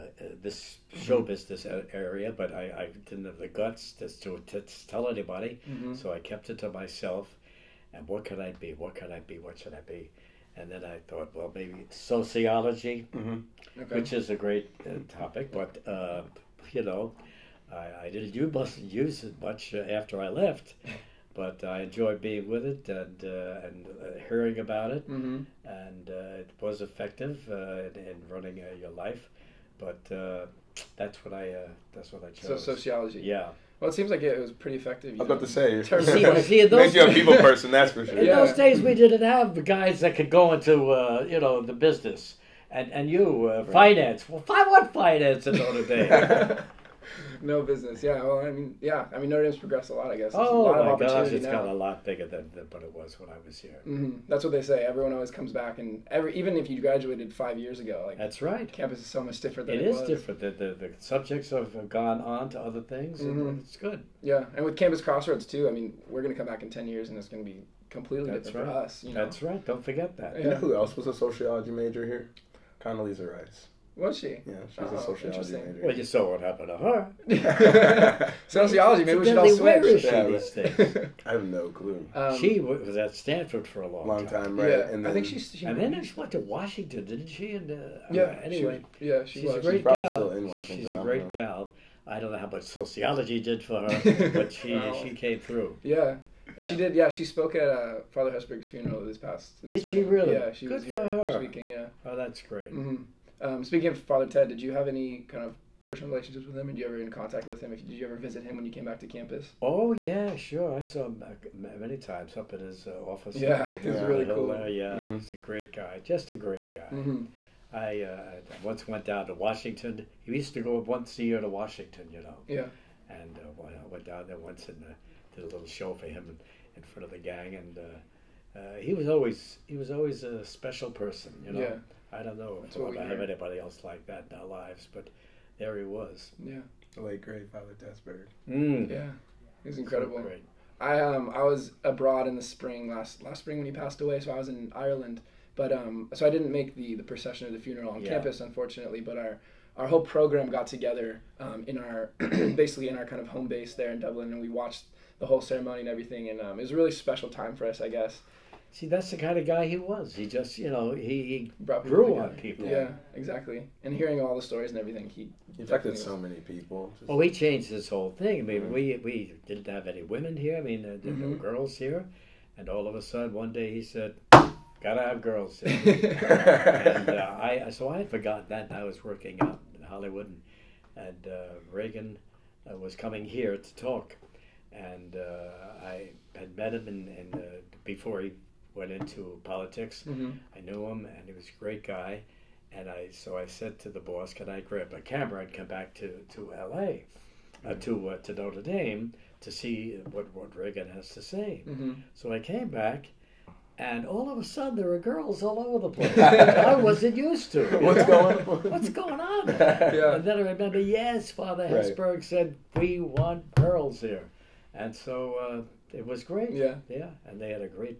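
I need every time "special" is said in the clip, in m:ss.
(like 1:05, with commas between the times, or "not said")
2:10, 2:36.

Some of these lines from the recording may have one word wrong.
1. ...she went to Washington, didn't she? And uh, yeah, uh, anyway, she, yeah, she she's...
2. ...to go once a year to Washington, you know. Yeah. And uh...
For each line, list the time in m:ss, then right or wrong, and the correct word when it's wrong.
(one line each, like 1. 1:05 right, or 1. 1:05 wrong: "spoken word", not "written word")
1. 1:26 right
2. 2:00 right.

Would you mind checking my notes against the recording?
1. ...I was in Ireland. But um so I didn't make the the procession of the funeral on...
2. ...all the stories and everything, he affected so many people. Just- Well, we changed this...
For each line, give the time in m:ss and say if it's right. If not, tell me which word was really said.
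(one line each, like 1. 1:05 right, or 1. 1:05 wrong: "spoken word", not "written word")
1. 2:24 right
2. 2:44 right.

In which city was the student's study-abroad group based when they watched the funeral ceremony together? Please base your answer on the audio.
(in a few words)
Dublin.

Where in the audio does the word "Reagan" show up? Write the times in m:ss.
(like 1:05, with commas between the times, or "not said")
3:01, 3:20.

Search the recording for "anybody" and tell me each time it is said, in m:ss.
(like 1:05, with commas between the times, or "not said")
0:05, 2:13.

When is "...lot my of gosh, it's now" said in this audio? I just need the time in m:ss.
0:50.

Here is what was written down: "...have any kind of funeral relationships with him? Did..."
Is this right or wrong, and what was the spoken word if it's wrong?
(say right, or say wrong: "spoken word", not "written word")
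wrong: "personal", not "funeral".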